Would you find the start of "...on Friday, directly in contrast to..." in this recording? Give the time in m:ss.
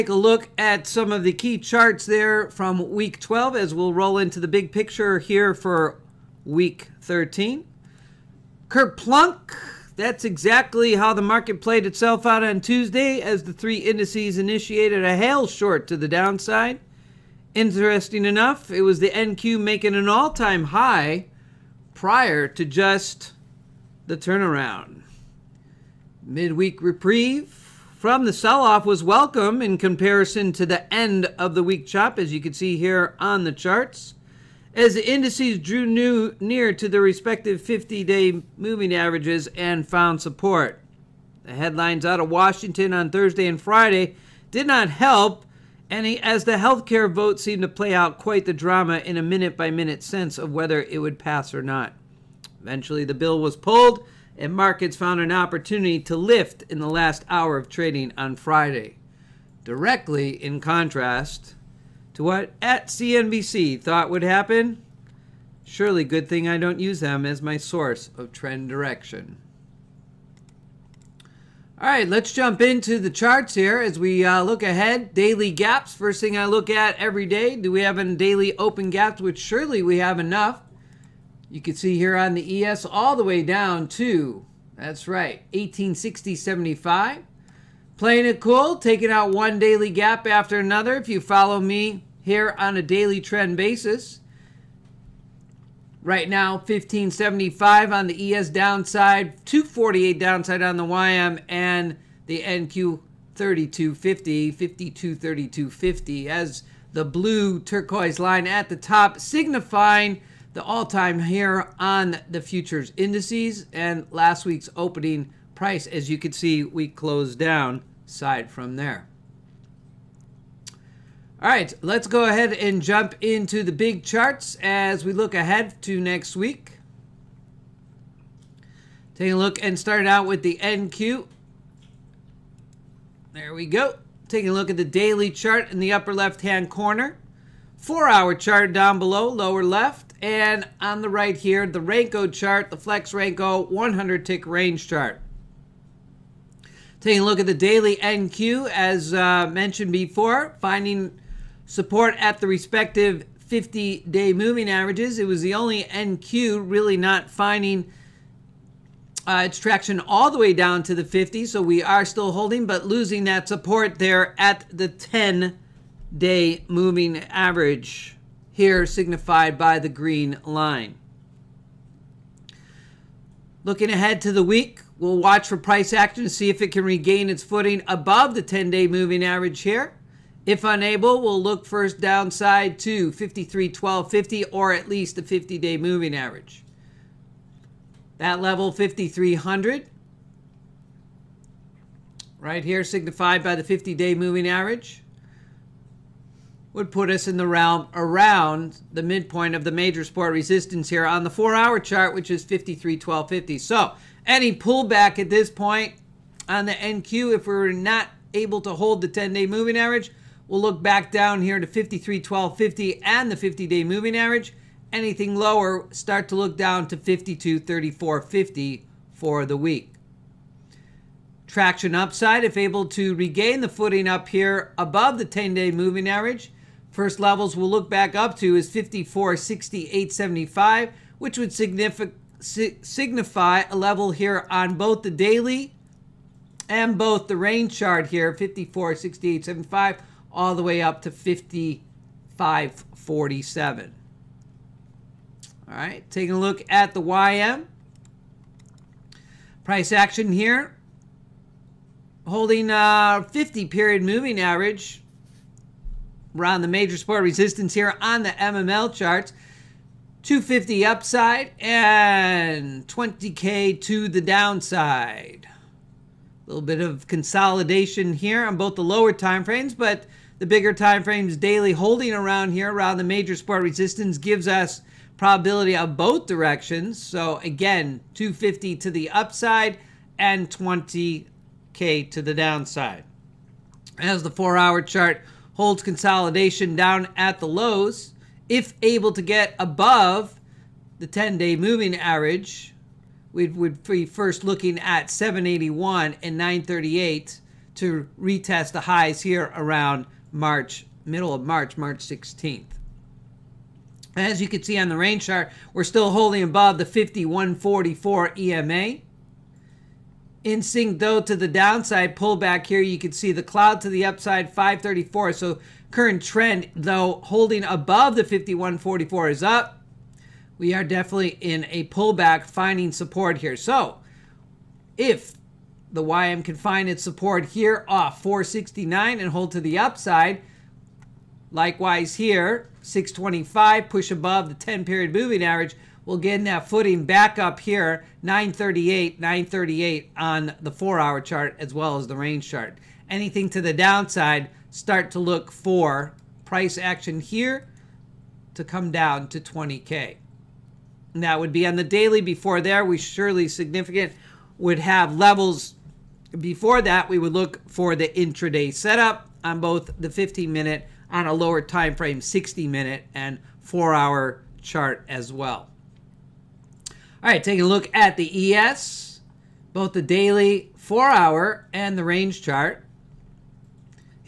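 0:58.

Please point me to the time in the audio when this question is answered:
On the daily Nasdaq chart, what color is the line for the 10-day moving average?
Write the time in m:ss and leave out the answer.
2:49.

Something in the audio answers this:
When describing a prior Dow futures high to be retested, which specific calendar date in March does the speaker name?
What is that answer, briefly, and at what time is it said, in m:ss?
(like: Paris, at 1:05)
March 16th, at 5:01.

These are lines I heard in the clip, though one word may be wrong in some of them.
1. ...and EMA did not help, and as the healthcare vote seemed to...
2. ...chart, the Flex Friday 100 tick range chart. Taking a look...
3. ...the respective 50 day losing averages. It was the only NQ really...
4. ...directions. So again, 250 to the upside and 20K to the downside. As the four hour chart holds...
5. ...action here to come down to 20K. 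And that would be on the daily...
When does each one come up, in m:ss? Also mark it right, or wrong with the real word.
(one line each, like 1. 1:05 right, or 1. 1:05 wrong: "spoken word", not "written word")
1. 0:43 wrong: "Friday", not "EMA"
2. 2:22 wrong: "Renko", not "Friday"
3. 2:32 wrong: "moving", not "losing"
4. 4:36 right
5. 5:46 right.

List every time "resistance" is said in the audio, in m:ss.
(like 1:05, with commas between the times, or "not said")
3:20, 4:17, 4:33.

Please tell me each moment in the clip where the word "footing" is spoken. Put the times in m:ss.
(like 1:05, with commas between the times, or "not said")
2:57, 3:43, 5:36.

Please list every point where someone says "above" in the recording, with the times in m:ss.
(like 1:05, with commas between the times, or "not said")
2:57, 3:44, 4:49, 5:06, 5:17, 5:34.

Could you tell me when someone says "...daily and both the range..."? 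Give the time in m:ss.
3:55.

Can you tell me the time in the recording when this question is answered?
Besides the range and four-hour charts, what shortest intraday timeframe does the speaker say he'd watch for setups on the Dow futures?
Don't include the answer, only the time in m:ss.
6:00.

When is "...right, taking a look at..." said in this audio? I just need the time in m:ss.
4:05.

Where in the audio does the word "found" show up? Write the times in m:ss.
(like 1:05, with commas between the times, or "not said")
0:39, 0:54.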